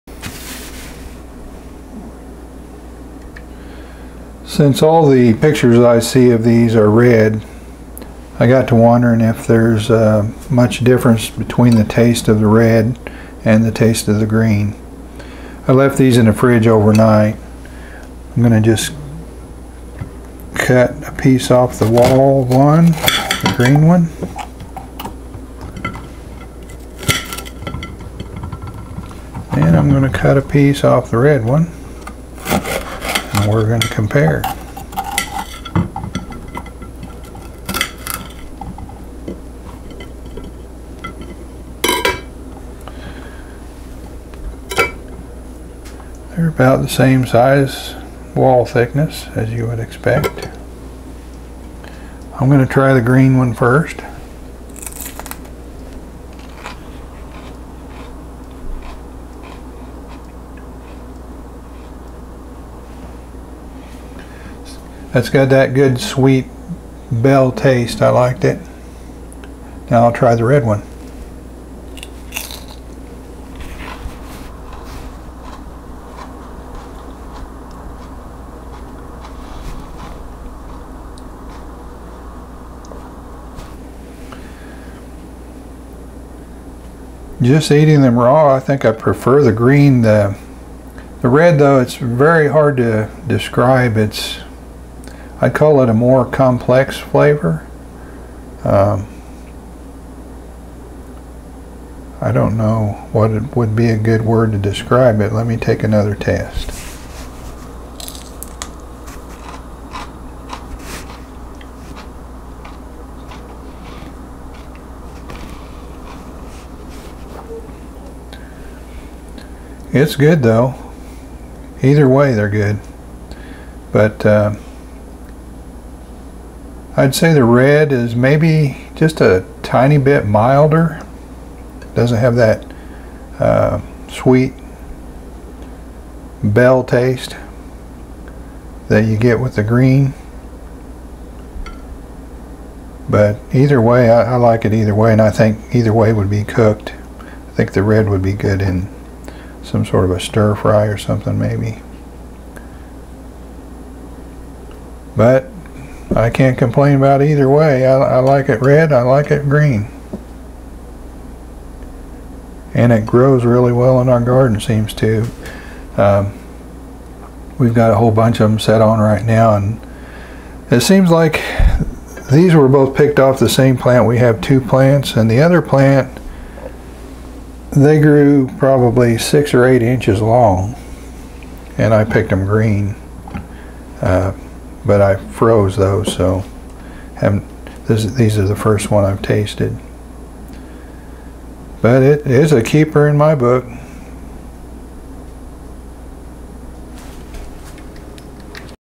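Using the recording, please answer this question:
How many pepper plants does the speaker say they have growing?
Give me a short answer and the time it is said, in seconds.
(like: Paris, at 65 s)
2, at 174 s.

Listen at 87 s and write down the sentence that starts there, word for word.
Just eating them raw, I think I prefer the green.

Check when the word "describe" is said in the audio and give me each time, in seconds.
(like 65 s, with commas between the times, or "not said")
93 s, 104 s.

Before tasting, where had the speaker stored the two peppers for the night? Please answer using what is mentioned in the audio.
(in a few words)
In the fridge.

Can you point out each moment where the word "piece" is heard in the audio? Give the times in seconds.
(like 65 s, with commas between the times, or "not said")
21 s, 30 s.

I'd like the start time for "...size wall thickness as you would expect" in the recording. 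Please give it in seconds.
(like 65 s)
47 s.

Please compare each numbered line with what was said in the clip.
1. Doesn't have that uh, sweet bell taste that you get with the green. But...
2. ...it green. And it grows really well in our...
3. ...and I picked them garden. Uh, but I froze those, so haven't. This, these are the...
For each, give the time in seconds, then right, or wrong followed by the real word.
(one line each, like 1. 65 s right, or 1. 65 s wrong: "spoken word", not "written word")
1. 131 s right
2. 159 s right
3. 181 s wrong: "green", not "garden".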